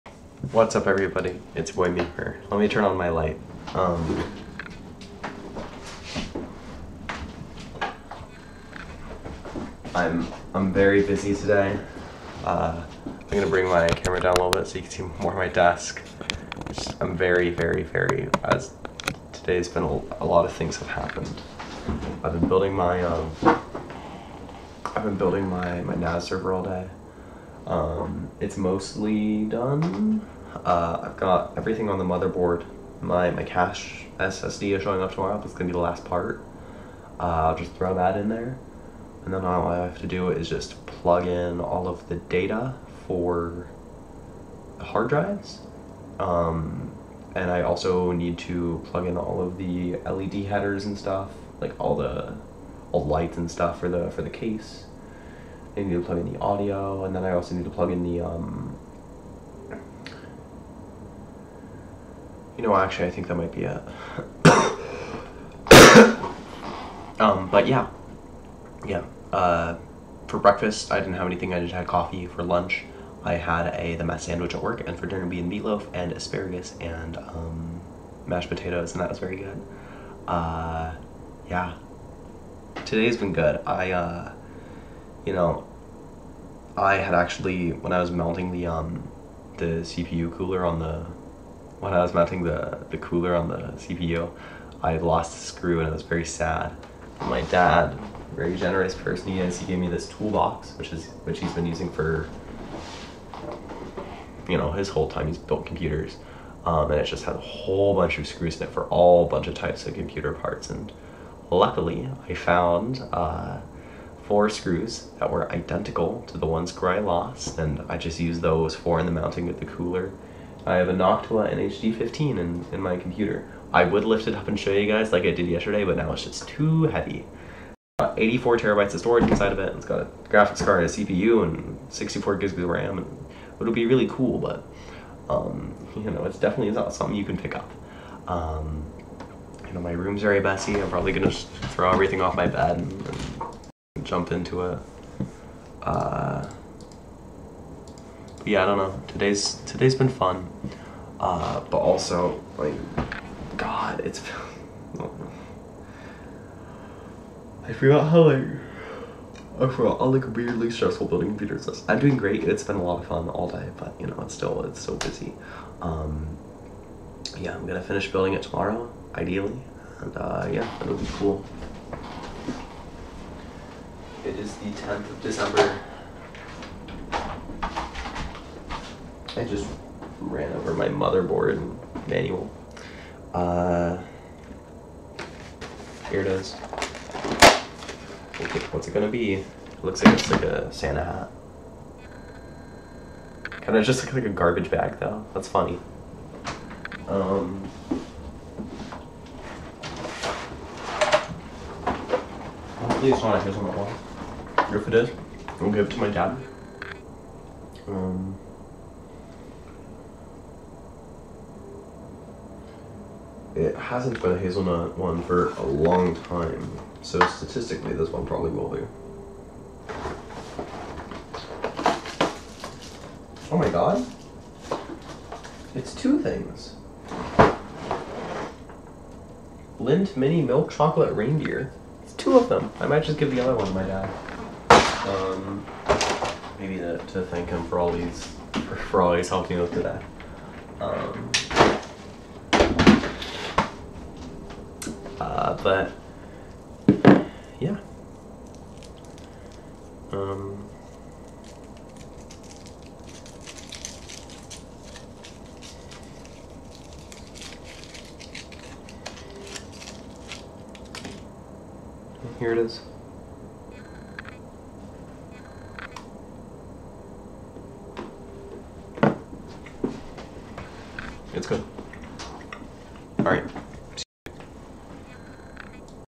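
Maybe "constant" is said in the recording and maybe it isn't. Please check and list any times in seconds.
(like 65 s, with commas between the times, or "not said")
not said.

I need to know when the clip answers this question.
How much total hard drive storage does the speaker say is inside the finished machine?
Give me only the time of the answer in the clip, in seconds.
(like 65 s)
127 s.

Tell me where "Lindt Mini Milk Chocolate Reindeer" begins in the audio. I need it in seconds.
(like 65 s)
229 s.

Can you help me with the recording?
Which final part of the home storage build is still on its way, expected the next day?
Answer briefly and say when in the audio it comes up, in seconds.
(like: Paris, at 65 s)
cache SSD, at 33 s.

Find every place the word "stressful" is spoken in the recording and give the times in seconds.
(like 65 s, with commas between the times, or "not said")
160 s.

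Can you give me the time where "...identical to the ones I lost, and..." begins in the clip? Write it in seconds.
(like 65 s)
115 s.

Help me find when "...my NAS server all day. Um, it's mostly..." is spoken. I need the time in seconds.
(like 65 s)
25 s.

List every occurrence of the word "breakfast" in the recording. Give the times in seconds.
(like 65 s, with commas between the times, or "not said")
70 s.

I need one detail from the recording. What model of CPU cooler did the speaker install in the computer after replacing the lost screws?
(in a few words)
Noctua NHD15.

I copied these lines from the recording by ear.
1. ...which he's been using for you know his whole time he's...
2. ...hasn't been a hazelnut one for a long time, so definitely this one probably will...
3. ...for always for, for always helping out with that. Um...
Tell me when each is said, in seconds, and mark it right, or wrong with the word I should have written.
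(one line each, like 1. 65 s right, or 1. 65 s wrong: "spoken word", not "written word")
1. 101 s right
2. 213 s wrong: "statistically", not "definitely"
3. 237 s right.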